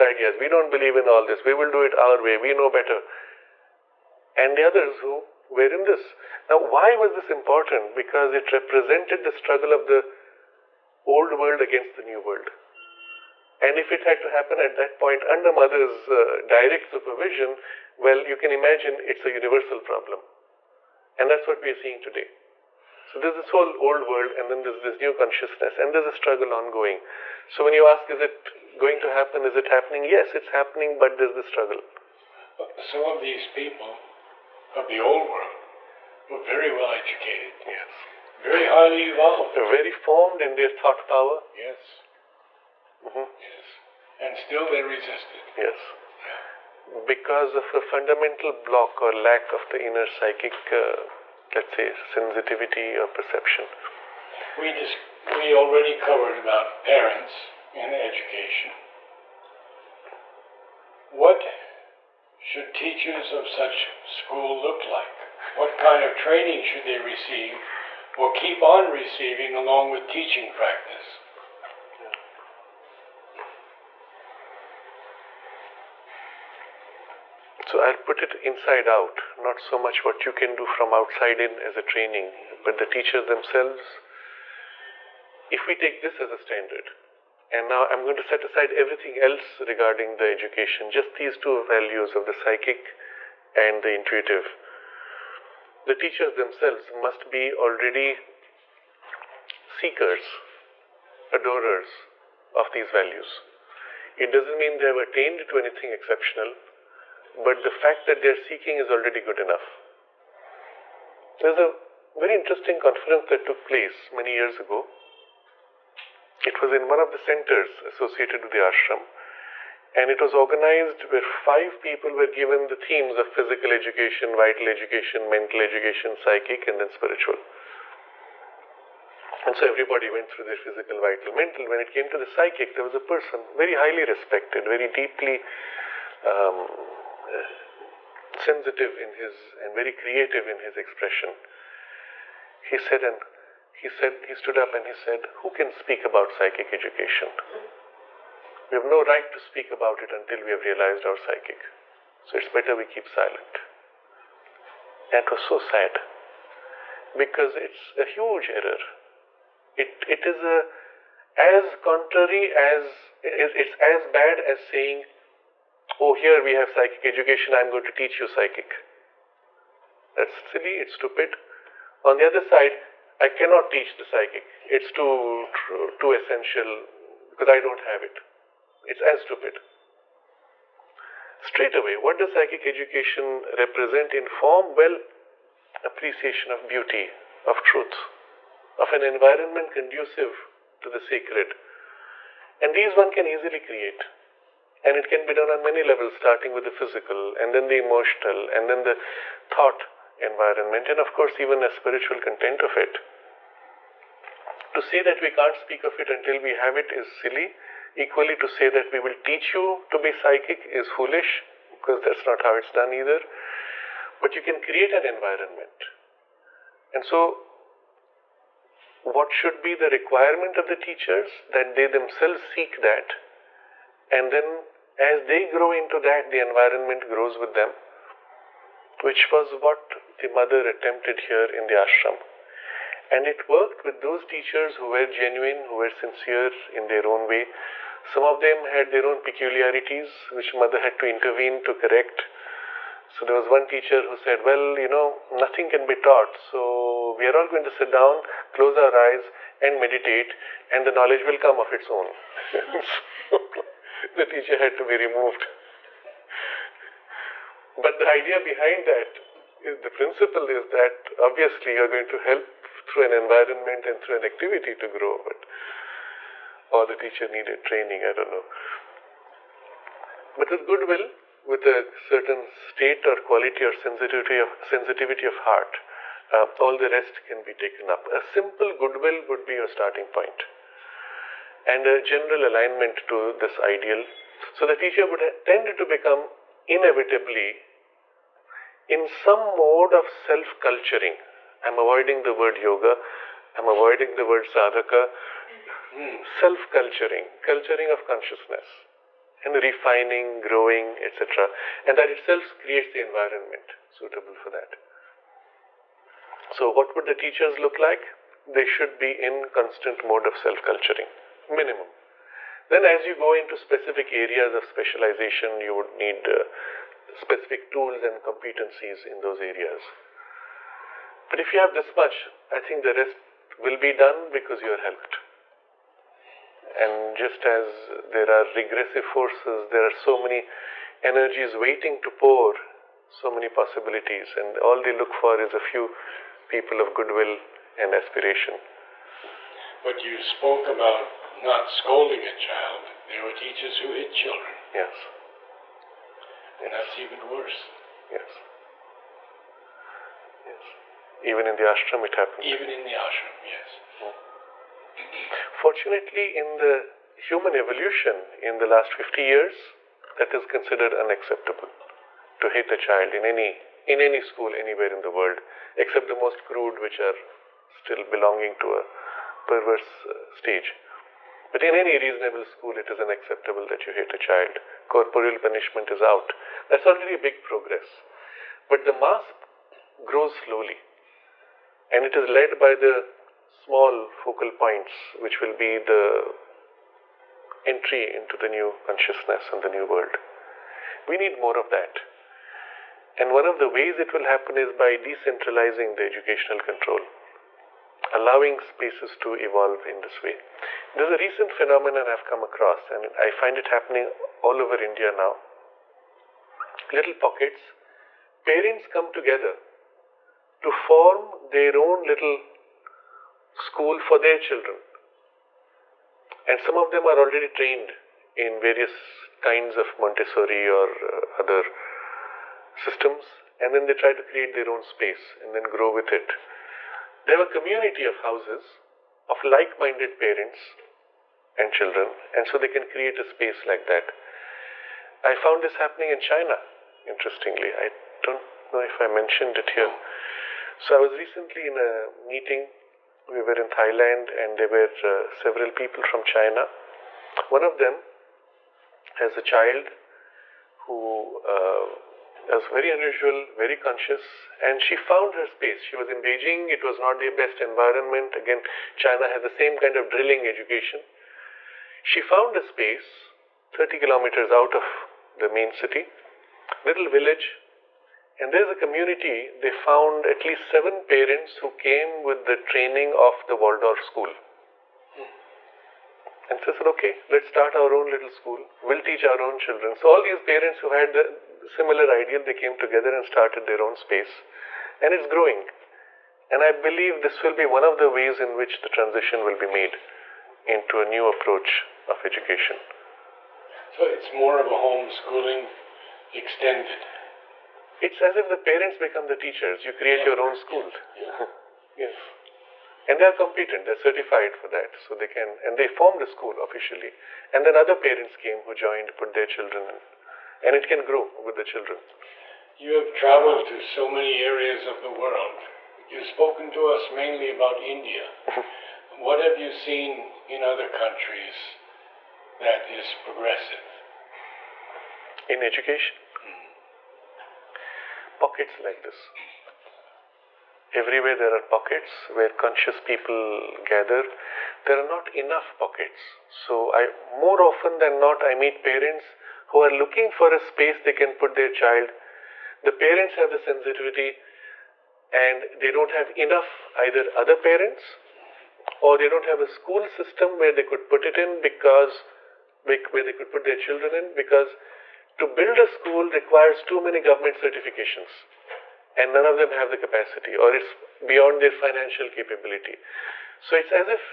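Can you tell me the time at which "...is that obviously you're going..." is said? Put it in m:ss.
4:20.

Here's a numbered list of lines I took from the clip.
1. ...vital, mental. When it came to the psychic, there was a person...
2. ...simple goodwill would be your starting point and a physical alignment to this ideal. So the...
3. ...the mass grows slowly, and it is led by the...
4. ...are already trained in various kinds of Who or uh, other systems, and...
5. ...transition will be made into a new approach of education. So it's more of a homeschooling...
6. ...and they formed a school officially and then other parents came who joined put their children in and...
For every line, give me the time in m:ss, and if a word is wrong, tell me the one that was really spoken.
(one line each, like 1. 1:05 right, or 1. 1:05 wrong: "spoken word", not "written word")
1. 2:11 right
2. 4:38 wrong: "general", not "physical"
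3. 6:18 right
4. 6:57 wrong: "Montessori", not "Who"
5. 8:08 right
6. 8:25 right.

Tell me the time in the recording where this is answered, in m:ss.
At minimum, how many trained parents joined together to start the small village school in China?
7:50.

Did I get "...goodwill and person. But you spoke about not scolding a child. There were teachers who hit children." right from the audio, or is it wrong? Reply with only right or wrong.
wrong.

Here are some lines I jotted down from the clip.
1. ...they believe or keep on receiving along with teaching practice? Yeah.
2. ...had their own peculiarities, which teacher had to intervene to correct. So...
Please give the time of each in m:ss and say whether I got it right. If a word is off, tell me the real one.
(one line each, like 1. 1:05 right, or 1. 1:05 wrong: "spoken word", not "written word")
1. 1:06 wrong: "receive", not "believe"
2. 3:58 wrong: "mother", not "teacher".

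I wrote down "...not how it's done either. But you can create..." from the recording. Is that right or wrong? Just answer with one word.
right.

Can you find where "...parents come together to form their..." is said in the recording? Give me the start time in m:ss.
6:48.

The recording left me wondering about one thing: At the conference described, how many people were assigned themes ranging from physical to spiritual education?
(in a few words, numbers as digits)
5.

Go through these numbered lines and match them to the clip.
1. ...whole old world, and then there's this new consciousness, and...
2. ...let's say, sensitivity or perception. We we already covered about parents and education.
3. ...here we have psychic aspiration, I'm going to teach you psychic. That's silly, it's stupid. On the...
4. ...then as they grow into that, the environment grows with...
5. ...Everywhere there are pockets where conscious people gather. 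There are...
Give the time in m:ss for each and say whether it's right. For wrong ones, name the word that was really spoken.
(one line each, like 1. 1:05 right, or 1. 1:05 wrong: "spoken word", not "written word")
1. 0:23 right
2. 0:51 right
3. 2:46 wrong: "education", not "aspiration"
4. 3:44 right
5. 8:51 right.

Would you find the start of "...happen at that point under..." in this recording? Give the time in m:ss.
0:14.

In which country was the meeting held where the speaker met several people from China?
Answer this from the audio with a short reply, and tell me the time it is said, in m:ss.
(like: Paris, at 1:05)
Thailand, at 7:23.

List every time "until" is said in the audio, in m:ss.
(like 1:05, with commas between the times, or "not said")
2:30, 3:26.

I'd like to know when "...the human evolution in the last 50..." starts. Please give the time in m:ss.
5:56.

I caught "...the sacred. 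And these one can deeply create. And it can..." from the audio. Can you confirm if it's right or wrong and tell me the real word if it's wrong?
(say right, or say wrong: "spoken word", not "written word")
wrong: "easily", not "deeply".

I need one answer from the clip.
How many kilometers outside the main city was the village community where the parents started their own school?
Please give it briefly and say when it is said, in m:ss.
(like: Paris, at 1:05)
30, at 7:43.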